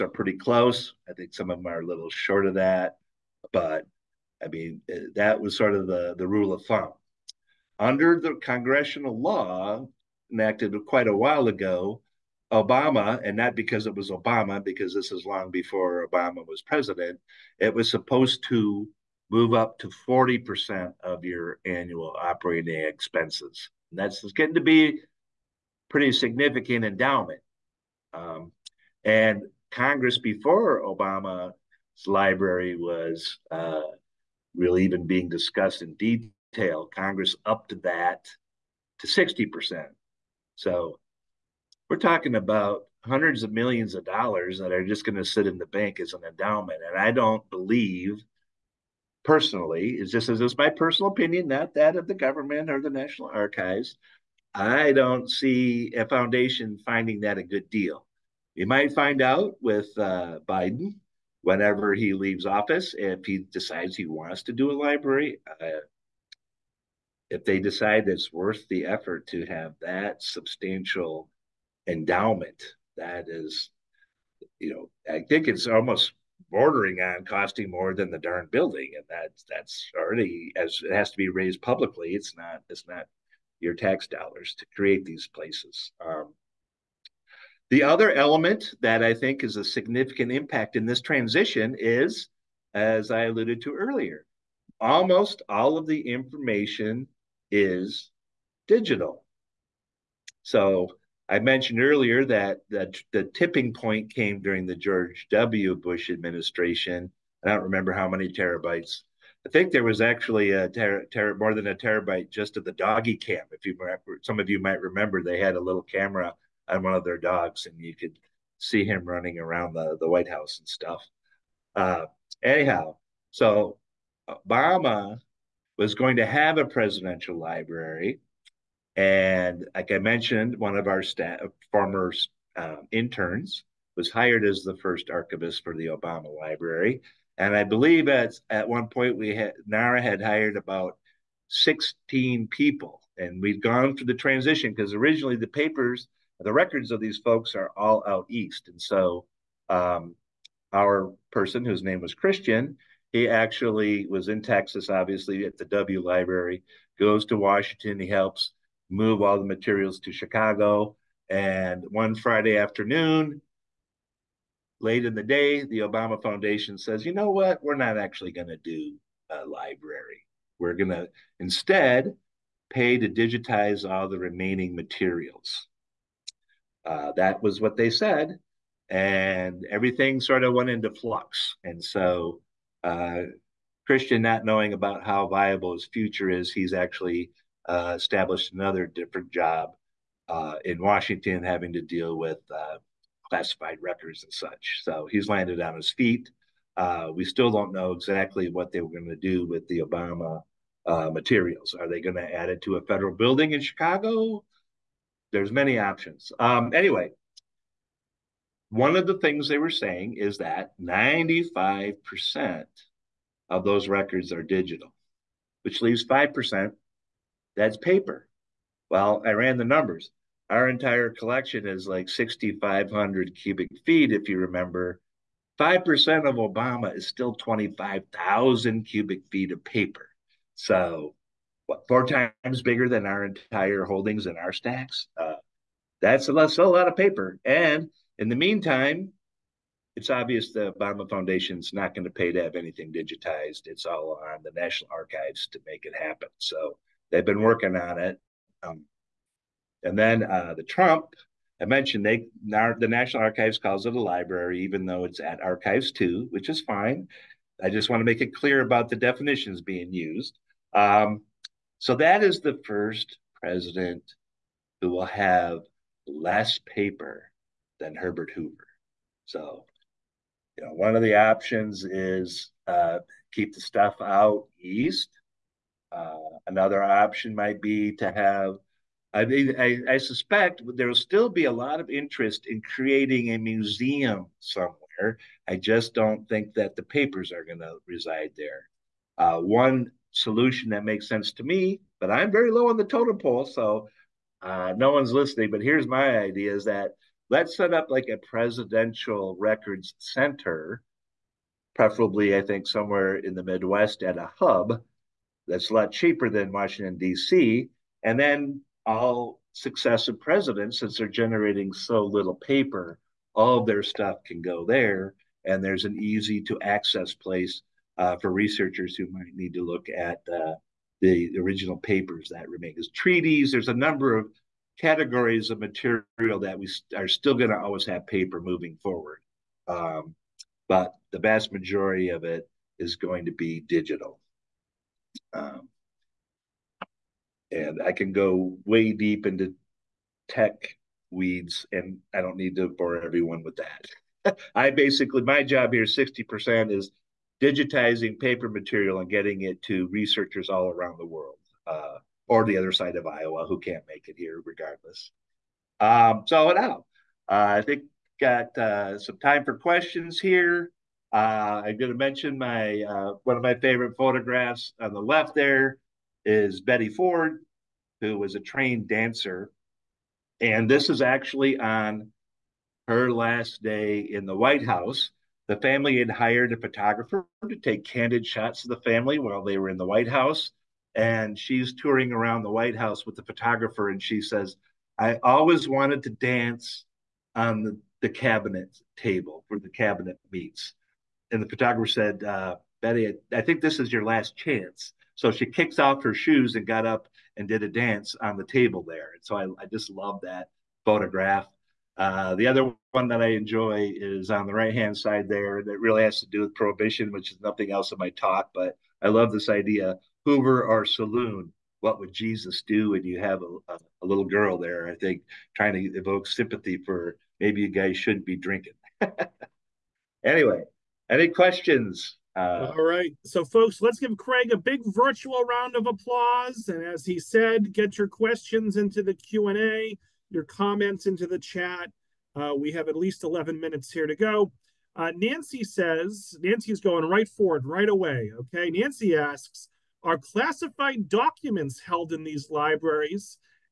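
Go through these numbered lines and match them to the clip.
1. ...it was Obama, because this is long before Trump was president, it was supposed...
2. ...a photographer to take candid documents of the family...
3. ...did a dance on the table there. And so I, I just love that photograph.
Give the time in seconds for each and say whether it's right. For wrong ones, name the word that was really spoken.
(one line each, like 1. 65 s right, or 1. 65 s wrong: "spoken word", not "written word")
1. 13 s wrong: "Obama", not "Trump"
2. 376 s wrong: "shots", not "documents"
3. 397 s right.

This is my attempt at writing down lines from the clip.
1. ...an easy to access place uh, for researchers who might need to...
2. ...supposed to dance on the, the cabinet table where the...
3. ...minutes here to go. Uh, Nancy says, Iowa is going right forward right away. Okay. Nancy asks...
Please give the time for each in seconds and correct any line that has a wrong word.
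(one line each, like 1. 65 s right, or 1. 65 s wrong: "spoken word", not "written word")
1. 315 s right
2. 385 s wrong: "wanted", not "supposed"
3. 433 s wrong: "Nancy", not "Iowa".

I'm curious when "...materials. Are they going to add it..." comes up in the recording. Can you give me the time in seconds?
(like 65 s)
201 s.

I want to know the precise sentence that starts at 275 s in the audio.
Uh, another option might be to have.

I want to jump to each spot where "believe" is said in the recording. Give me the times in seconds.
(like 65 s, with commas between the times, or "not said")
47 s, 137 s.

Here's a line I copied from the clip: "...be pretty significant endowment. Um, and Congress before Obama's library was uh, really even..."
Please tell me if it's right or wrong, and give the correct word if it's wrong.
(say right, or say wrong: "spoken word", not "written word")
right.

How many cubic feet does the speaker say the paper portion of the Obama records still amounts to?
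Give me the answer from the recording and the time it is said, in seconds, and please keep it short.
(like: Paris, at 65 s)
25,000 cubic feet, at 227 s.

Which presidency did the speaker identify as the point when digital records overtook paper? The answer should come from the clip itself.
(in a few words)
George W. Bush.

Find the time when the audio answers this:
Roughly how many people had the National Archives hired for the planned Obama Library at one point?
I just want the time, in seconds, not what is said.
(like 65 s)
141 s.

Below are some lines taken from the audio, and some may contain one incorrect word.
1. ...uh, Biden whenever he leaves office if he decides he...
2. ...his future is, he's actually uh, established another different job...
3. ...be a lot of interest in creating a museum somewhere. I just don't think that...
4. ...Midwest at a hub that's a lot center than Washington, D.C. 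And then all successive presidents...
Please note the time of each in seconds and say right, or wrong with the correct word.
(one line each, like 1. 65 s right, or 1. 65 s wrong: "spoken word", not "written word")
1. 59 s right
2. 185 s right
3. 281 s right
4. 303 s wrong: "cheaper", not "center".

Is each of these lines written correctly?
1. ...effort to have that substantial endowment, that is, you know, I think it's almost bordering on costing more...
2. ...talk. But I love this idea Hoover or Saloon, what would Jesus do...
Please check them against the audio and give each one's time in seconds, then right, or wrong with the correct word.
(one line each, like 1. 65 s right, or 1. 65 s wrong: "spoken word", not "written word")
1. 68 s right
2. 408 s right.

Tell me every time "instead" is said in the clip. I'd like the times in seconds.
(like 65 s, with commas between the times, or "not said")
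171 s.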